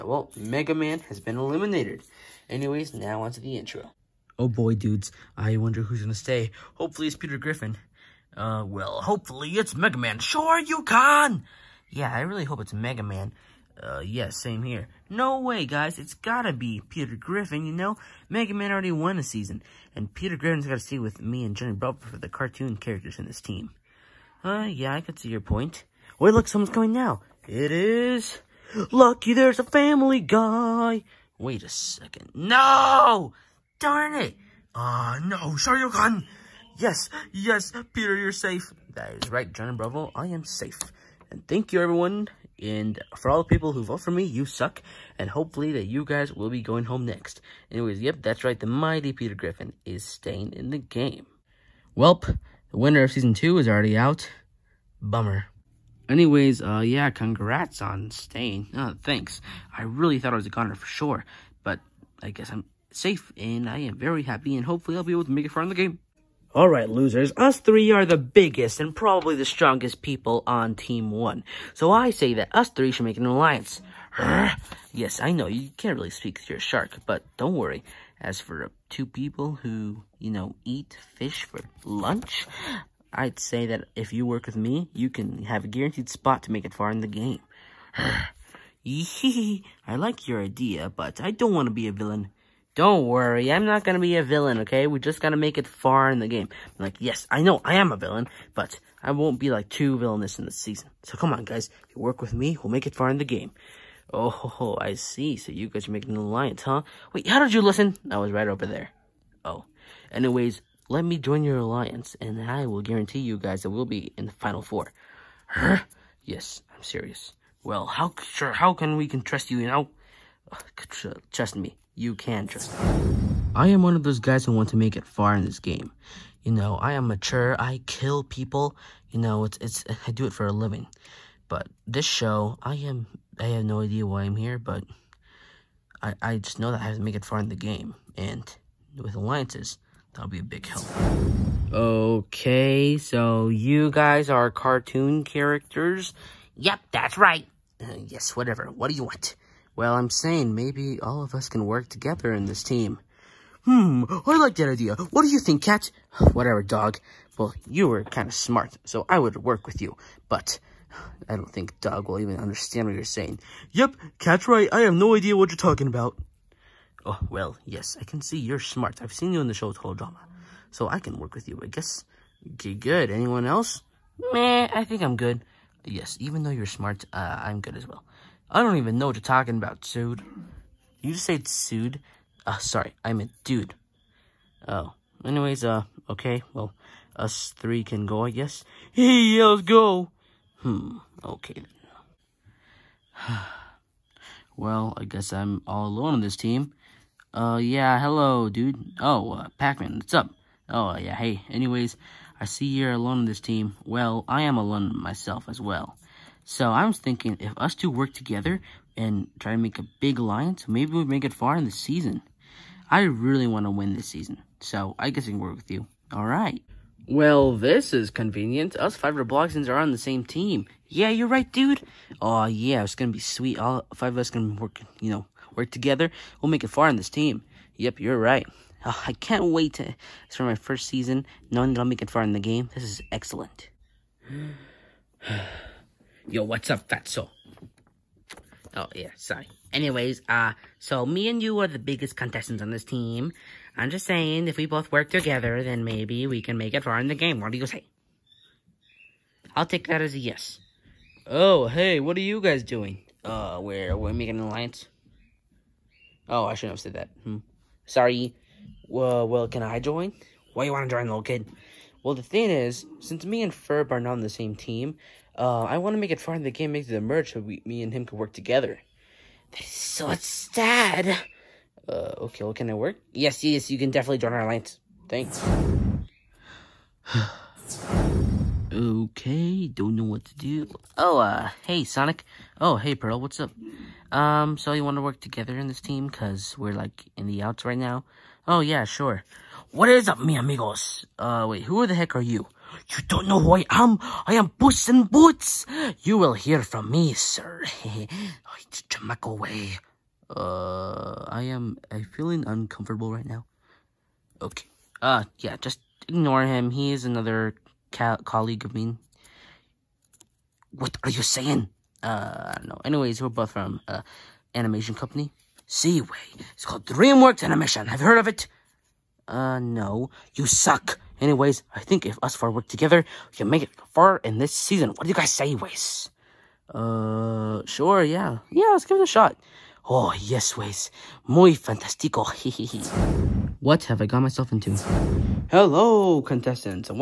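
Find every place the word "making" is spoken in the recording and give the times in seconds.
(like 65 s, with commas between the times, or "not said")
105 s, 254 s.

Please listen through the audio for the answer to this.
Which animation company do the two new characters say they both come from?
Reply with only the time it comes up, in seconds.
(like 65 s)
316 s.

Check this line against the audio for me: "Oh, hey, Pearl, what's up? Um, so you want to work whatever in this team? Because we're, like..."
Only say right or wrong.
wrong.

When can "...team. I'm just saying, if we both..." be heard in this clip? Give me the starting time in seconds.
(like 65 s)
242 s.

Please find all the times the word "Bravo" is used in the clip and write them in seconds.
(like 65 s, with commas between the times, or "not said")
21 s, 39 s.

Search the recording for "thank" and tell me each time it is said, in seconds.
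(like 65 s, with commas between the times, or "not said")
41 s, 59 s, 275 s.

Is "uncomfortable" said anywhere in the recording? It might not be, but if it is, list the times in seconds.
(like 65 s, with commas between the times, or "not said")
302 s.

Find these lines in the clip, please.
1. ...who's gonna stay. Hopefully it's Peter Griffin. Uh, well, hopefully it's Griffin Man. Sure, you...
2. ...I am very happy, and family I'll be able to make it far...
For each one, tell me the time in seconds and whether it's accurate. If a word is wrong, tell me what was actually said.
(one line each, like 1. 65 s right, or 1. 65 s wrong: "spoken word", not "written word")
1. 5 s wrong: "Mega", not "Griffin"
2. 63 s wrong: "hopefully", not "family".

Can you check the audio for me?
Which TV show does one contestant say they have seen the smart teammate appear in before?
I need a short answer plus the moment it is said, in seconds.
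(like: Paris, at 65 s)
Total Drama, at 169 s.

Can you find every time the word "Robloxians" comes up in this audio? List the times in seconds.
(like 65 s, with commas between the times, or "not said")
219 s.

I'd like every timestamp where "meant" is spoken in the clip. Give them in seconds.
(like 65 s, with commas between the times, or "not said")
183 s.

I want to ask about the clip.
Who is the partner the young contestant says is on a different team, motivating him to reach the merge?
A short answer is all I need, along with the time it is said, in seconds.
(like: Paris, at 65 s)
Ferb, at 263 s.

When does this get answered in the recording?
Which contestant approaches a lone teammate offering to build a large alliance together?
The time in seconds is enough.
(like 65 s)
199 s.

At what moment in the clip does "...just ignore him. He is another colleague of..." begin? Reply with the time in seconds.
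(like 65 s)
305 s.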